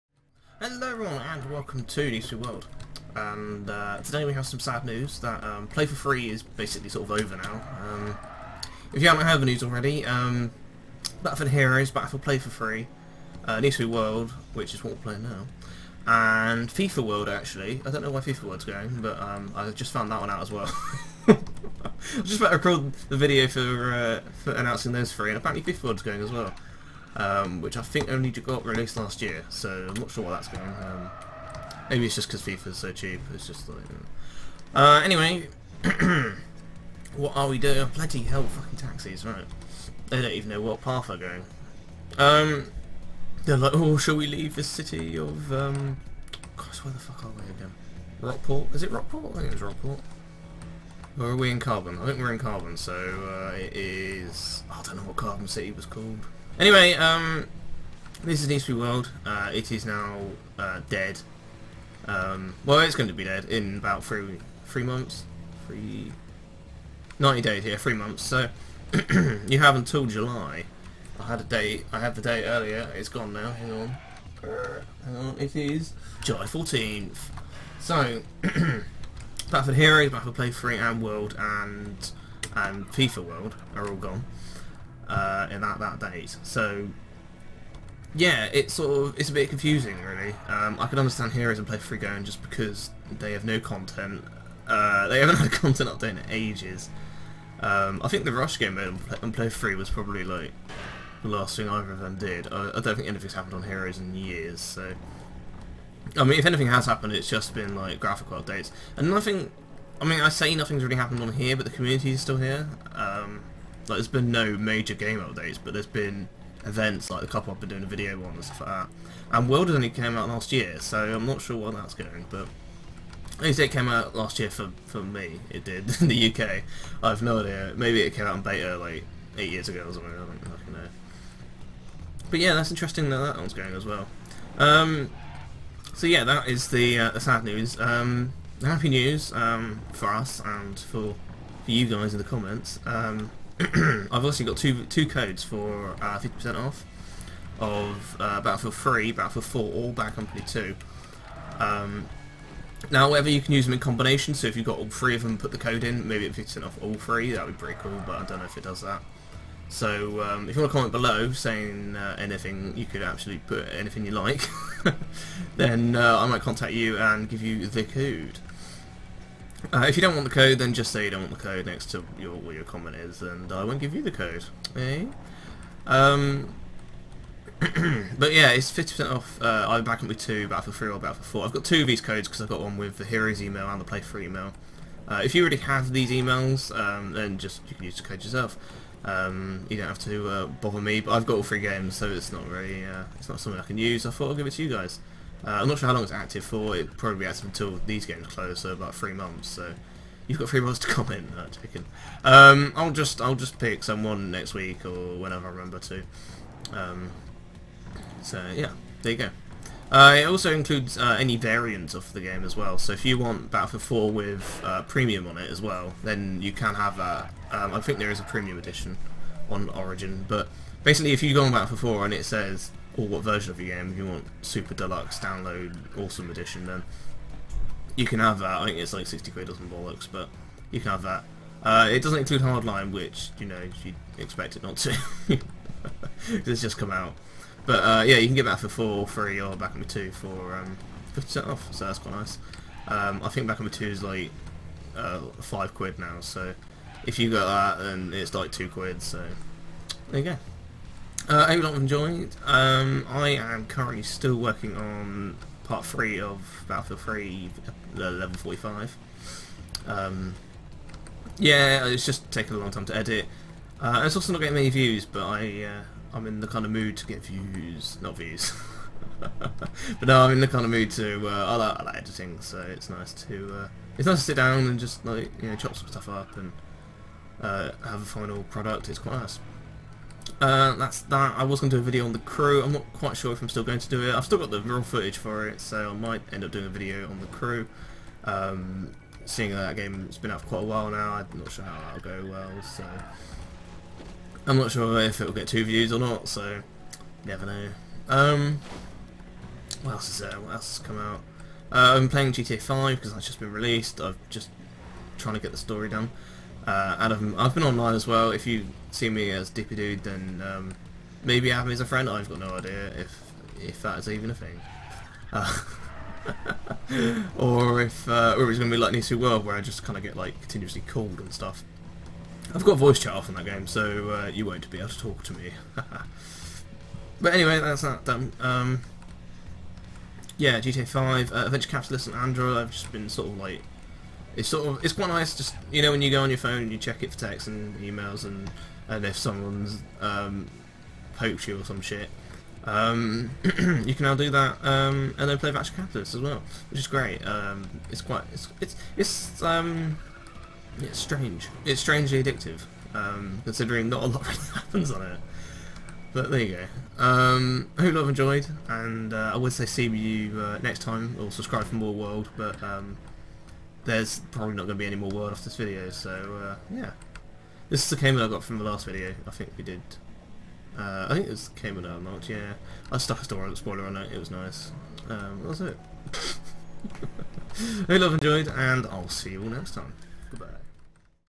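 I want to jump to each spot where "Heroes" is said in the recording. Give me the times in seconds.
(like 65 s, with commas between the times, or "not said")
11 s, 79 s, 91 s, 103 s, 183 s.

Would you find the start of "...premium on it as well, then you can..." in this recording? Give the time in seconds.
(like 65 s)
214 s.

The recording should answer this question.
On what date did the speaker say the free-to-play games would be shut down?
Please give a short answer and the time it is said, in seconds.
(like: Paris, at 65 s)
July 14th, at 76 s.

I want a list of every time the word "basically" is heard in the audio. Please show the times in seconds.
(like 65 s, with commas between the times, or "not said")
6 s, 220 s.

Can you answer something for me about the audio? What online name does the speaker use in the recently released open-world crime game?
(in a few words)
Dippy Dude.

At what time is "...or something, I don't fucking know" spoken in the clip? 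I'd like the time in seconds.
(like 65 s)
129 s.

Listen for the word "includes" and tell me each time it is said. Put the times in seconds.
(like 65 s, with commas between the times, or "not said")
210 s, 232 s.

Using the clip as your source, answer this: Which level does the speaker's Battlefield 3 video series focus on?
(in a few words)
level 45.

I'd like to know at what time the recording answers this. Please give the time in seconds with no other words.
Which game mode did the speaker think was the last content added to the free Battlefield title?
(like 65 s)
98 s.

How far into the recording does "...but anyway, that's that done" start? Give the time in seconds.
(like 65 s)
327 s.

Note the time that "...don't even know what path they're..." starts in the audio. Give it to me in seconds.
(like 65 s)
40 s.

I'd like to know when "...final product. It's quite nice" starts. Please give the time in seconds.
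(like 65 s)
278 s.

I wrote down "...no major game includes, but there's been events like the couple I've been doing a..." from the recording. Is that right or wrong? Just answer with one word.
wrong.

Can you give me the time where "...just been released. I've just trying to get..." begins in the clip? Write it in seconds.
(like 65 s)
303 s.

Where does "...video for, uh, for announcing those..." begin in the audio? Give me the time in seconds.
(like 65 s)
23 s.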